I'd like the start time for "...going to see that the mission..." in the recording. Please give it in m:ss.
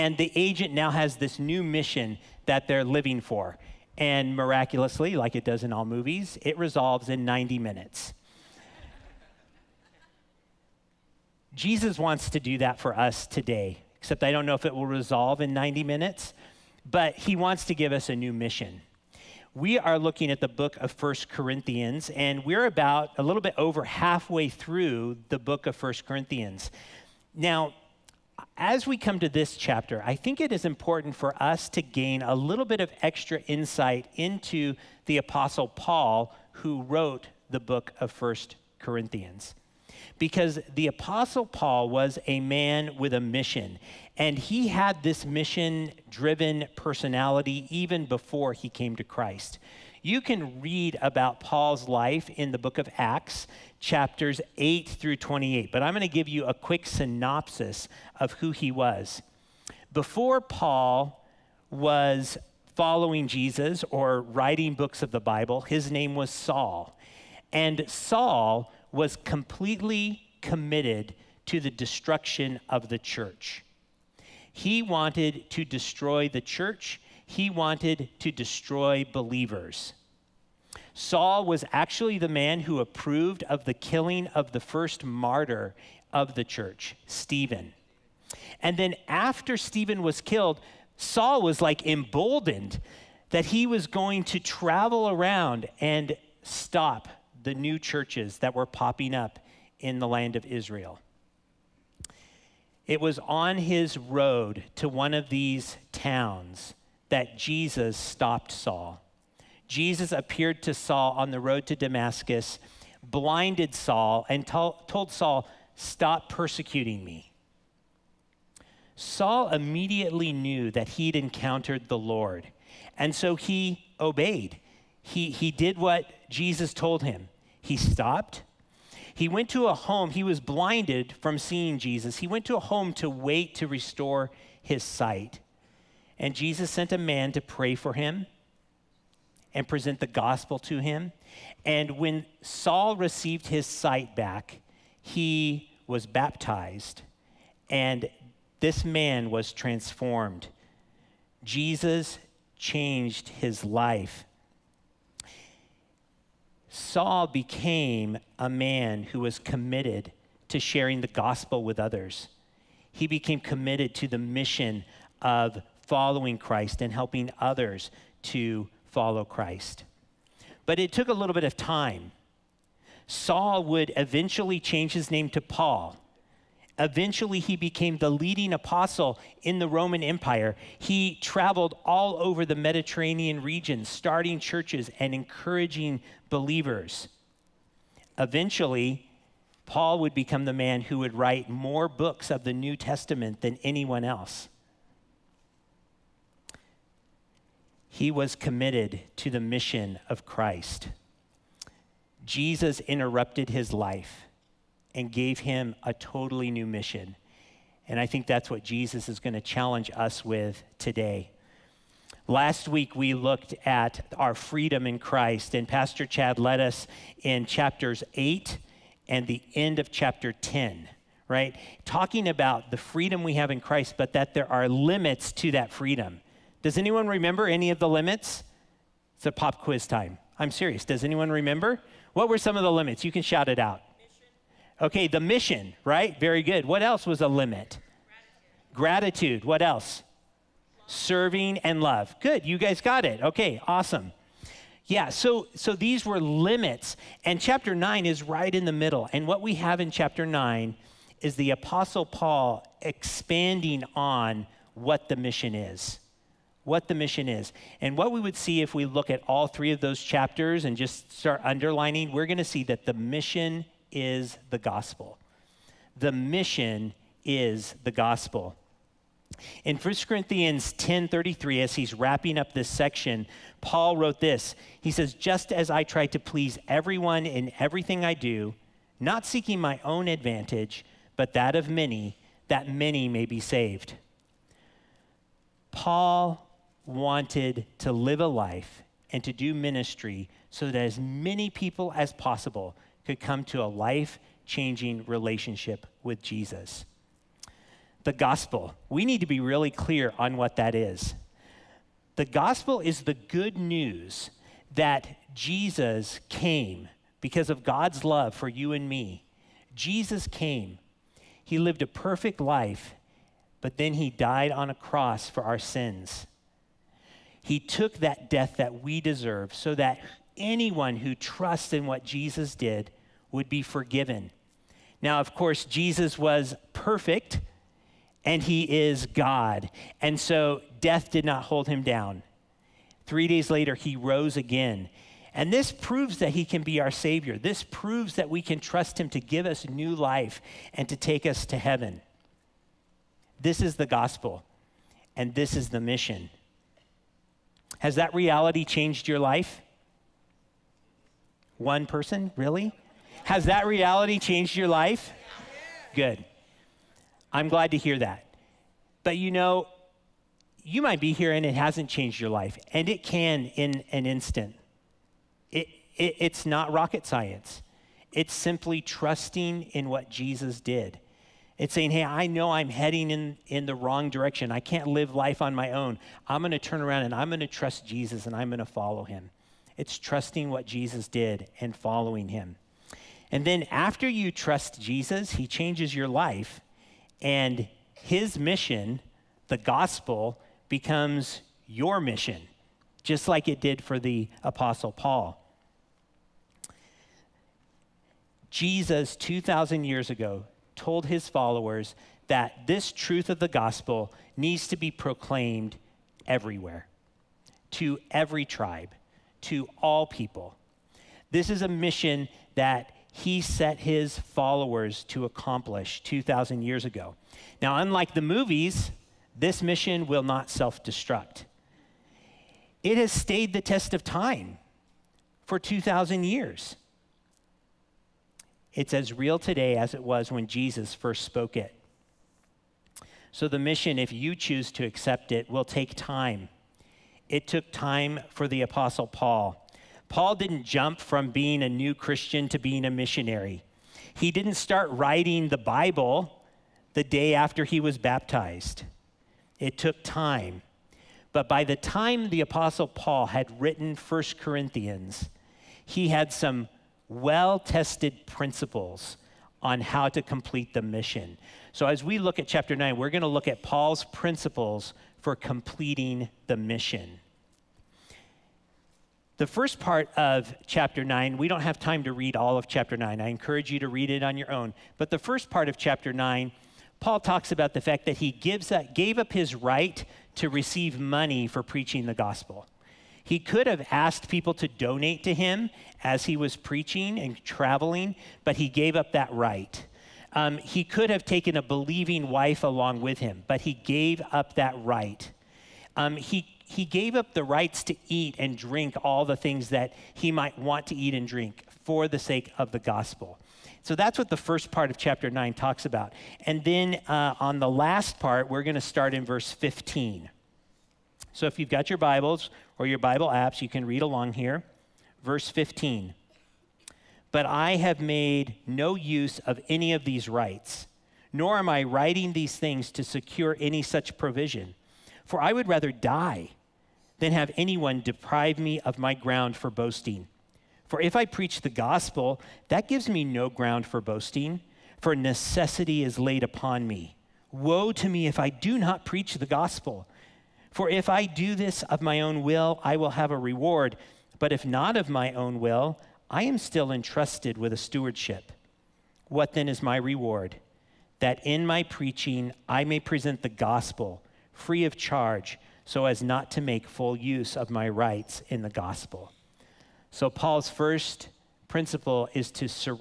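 4:22.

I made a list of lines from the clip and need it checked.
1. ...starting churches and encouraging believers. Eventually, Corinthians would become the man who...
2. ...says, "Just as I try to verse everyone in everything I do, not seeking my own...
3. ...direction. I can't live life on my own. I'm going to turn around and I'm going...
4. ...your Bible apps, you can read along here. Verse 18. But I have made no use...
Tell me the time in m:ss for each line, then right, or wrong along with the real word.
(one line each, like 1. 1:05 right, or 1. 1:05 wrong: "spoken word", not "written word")
1. 3:03 wrong: "Paul", not "Corinthians"
2. 4:34 wrong: "please", not "verse"
3. 6:14 right
4. 8:32 wrong: "15", not "18".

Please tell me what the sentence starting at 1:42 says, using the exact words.
It was on his road to one of these towns that Jesus stopped Saul.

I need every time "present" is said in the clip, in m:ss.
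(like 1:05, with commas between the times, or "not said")
2:19, 9:12.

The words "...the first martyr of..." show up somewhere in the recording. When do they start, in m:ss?
1:24.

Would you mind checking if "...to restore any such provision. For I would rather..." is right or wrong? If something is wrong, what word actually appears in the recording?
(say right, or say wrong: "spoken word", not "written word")
wrong: "secure", not "restore".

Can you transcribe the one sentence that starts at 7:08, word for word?
It's as real today as it was when Jesus first spoke it.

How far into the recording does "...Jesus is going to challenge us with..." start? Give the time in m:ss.
3:28.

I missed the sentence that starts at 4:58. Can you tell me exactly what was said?
The gospel, we need to be really clear on what that is.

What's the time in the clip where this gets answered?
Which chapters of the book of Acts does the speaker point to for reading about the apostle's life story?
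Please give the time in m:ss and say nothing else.
0:53.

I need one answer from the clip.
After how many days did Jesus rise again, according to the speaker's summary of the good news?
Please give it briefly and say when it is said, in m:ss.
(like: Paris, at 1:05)
3, at 5:33.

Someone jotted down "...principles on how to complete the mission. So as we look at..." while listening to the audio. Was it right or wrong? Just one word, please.
right.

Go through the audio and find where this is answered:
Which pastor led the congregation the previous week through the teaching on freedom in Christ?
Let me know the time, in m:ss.
3:35.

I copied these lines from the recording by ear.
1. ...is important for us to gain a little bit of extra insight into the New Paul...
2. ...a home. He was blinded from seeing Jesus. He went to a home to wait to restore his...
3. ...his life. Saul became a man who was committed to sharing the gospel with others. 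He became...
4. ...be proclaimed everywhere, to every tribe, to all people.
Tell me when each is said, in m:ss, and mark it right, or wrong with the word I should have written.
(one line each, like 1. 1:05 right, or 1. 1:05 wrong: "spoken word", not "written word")
1. 0:30 wrong: "Apostle", not "New"
2. 2:09 right
3. 2:33 right
4. 6:44 right.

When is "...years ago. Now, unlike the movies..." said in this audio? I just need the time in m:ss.
6:56.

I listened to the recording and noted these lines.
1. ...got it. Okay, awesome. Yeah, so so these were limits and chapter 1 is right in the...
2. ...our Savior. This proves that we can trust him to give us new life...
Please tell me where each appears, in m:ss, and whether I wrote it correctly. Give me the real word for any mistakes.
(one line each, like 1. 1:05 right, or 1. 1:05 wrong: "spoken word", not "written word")
1. 4:02 wrong: "9", not "1"
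2. 5:36 right.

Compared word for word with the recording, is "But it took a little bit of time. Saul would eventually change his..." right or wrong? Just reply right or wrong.
right.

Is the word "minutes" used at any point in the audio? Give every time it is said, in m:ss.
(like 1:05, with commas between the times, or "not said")
0:07, 0:15.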